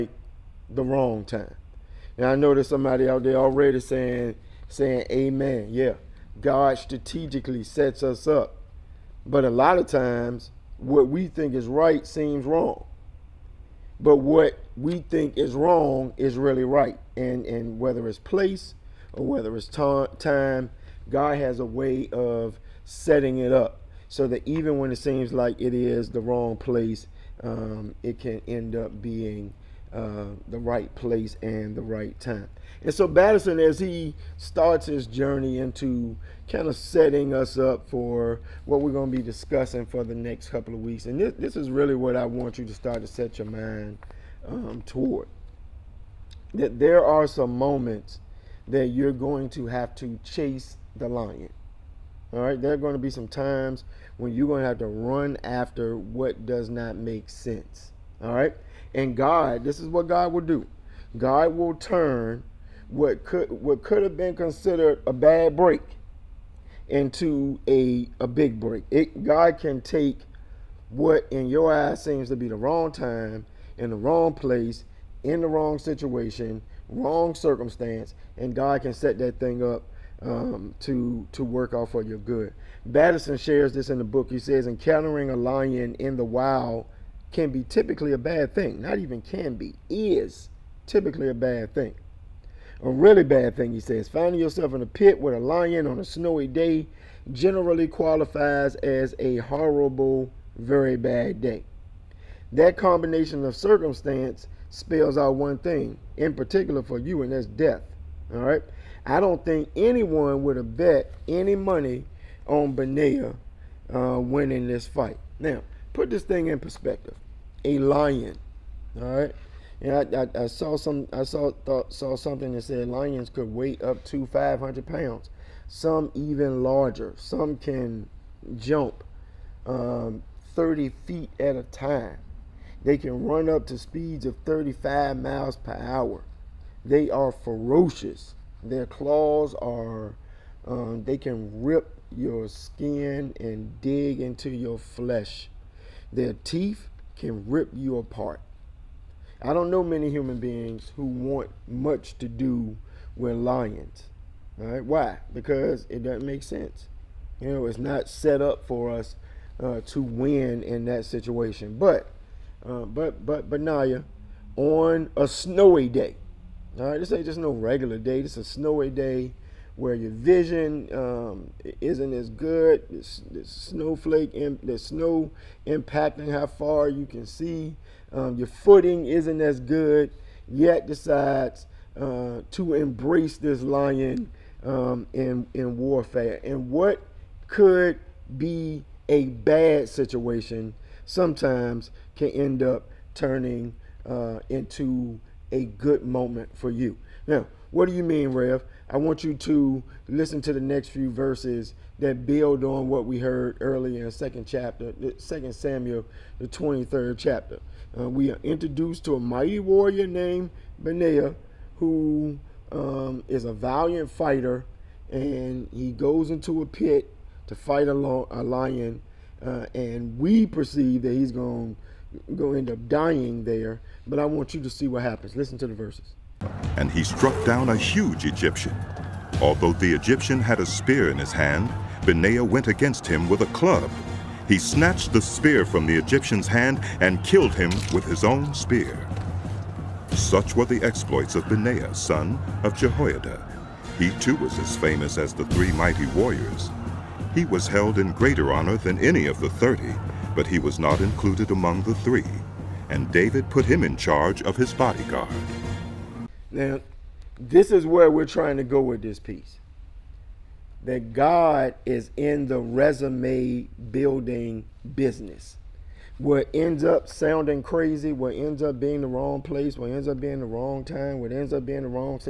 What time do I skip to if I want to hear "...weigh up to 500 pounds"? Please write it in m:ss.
2:03.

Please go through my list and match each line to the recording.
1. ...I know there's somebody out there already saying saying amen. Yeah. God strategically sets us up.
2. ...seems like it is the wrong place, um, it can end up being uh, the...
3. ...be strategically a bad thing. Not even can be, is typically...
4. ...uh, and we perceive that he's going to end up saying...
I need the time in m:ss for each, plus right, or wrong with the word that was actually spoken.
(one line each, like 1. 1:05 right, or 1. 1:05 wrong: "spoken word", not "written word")
1. 0:02 right
2. 0:24 right
3. 1:27 wrong: "typically", not "strategically"
4. 3:39 wrong: "dying", not "saying".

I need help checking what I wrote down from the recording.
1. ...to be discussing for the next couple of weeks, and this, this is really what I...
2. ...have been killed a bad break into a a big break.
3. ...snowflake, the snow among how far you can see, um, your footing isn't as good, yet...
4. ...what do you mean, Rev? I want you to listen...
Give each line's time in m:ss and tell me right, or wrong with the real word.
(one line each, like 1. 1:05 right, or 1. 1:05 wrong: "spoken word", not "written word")
1. 0:39 right
2. 1:04 wrong: "considered", not "killed"
3. 2:53 wrong: "impacting", not "among"
4. 3:17 right.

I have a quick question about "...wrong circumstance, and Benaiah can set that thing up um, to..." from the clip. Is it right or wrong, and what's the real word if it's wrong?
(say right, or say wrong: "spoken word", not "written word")
wrong: "God", not "Benaiah".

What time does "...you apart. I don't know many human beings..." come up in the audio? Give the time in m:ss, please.
2:27.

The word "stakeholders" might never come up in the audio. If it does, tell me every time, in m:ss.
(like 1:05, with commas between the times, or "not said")
not said.